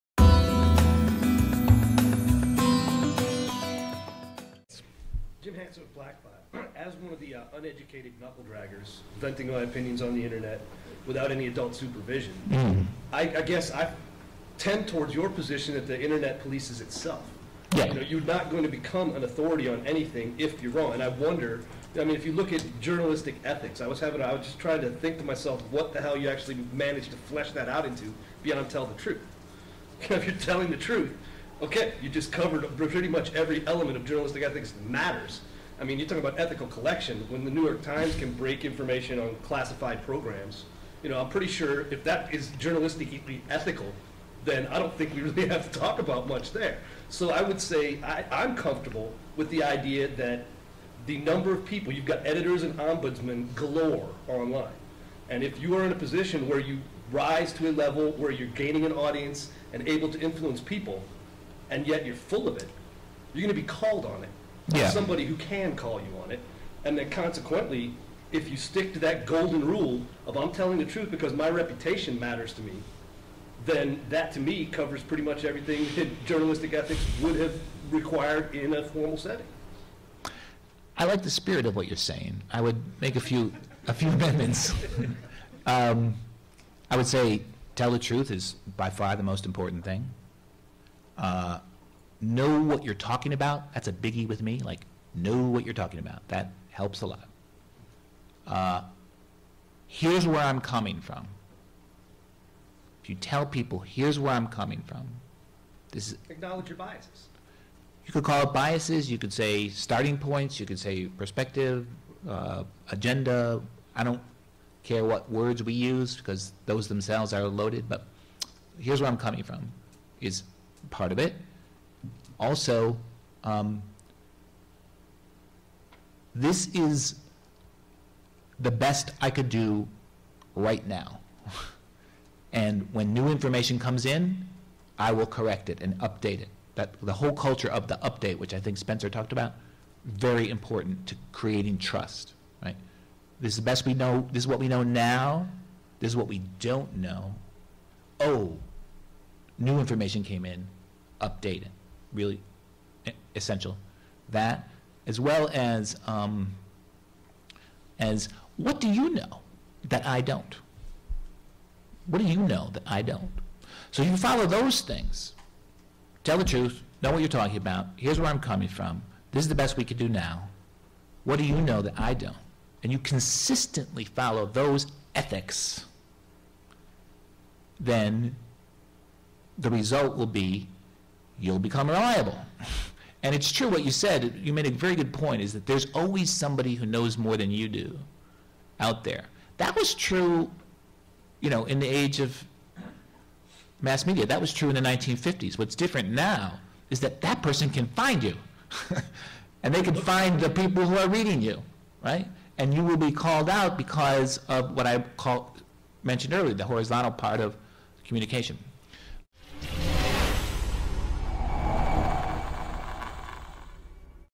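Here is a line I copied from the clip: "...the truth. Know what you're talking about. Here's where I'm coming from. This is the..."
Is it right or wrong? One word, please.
right.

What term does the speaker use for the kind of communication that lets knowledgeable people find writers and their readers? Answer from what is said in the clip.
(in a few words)
horizontal.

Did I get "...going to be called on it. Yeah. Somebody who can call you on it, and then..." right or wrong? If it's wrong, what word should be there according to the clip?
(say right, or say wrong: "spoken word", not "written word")
right.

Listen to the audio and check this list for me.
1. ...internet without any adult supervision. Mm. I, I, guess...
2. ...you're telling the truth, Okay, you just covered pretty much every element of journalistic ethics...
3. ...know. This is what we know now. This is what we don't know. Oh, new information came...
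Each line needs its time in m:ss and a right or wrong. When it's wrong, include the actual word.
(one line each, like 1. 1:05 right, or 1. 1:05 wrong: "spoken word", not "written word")
1. 0:10 right
2. 0:30 right
3. 2:23 right.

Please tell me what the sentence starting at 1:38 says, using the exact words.
Uh, here's where I'm coming from.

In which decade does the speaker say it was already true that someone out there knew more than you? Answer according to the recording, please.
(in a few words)
1950s.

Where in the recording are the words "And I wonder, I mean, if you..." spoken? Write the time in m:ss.
0:20.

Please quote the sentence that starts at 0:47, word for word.
So I would say I, I'm comfortable with the idea that the number of people, you've got editors and ombudsmen galore online.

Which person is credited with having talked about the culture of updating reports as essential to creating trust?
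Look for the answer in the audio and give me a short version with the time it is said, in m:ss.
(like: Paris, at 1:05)
Spencer, at 2:18.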